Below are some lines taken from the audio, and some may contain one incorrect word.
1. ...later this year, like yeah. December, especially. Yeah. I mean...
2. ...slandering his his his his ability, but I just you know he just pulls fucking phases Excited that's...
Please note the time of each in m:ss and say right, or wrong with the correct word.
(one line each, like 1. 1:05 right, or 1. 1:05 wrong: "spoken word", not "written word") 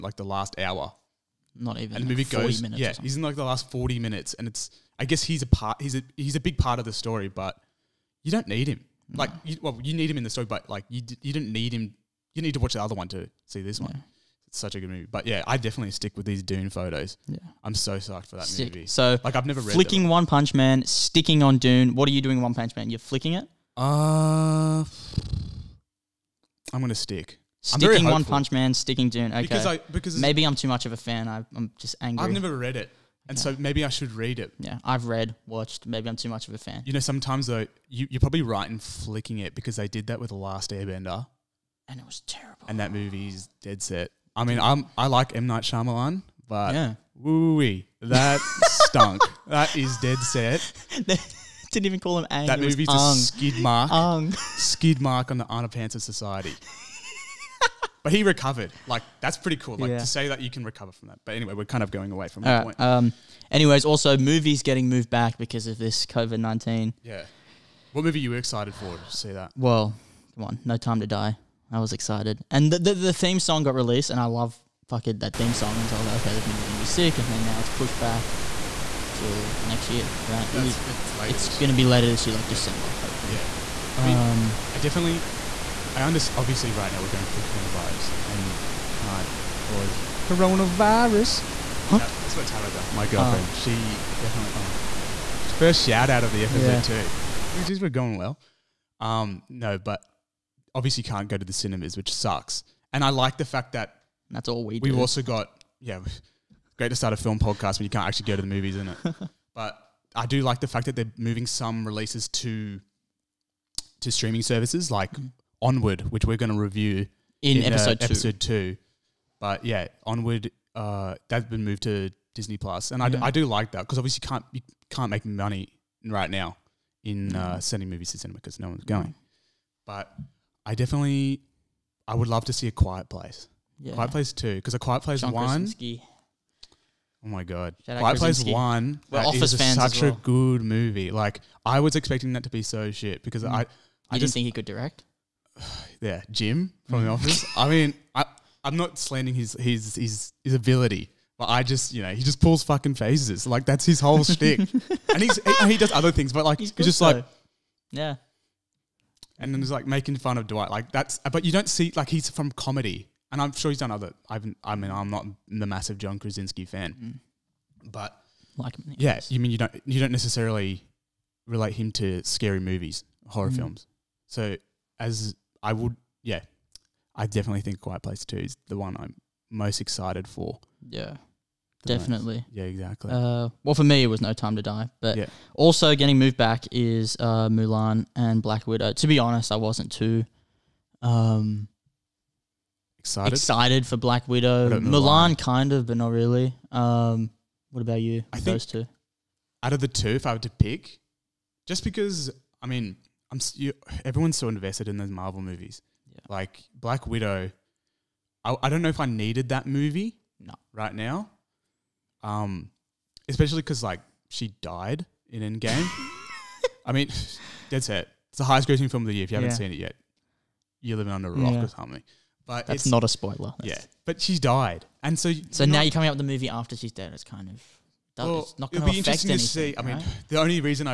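1. 1:21 wrong: "hopefully", not "especially"
2. 2:28 wrong: "Like", not "Excited".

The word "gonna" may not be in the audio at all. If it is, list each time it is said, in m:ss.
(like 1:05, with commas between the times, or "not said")
0:26, 1:16.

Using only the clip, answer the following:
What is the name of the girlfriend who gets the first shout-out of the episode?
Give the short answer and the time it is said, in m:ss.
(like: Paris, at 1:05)
Tabitha, at 1:32.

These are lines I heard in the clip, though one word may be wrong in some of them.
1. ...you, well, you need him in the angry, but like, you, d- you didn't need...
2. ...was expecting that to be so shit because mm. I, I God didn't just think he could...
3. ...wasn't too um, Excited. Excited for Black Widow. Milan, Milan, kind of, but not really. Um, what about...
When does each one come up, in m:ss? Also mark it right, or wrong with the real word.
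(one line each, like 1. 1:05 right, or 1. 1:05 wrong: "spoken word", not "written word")
1. 0:09 wrong: "story", not "angry"
2. 2:21 wrong: "You", not "God"
3. 3:09 right.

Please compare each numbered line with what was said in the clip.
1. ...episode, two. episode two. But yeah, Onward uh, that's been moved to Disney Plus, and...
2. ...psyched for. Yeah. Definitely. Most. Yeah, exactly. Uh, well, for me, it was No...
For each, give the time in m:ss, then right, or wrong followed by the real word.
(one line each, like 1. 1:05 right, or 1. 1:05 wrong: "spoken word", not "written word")
1. 1:57 right
2. 2:59 wrong: "excited", not "psyched".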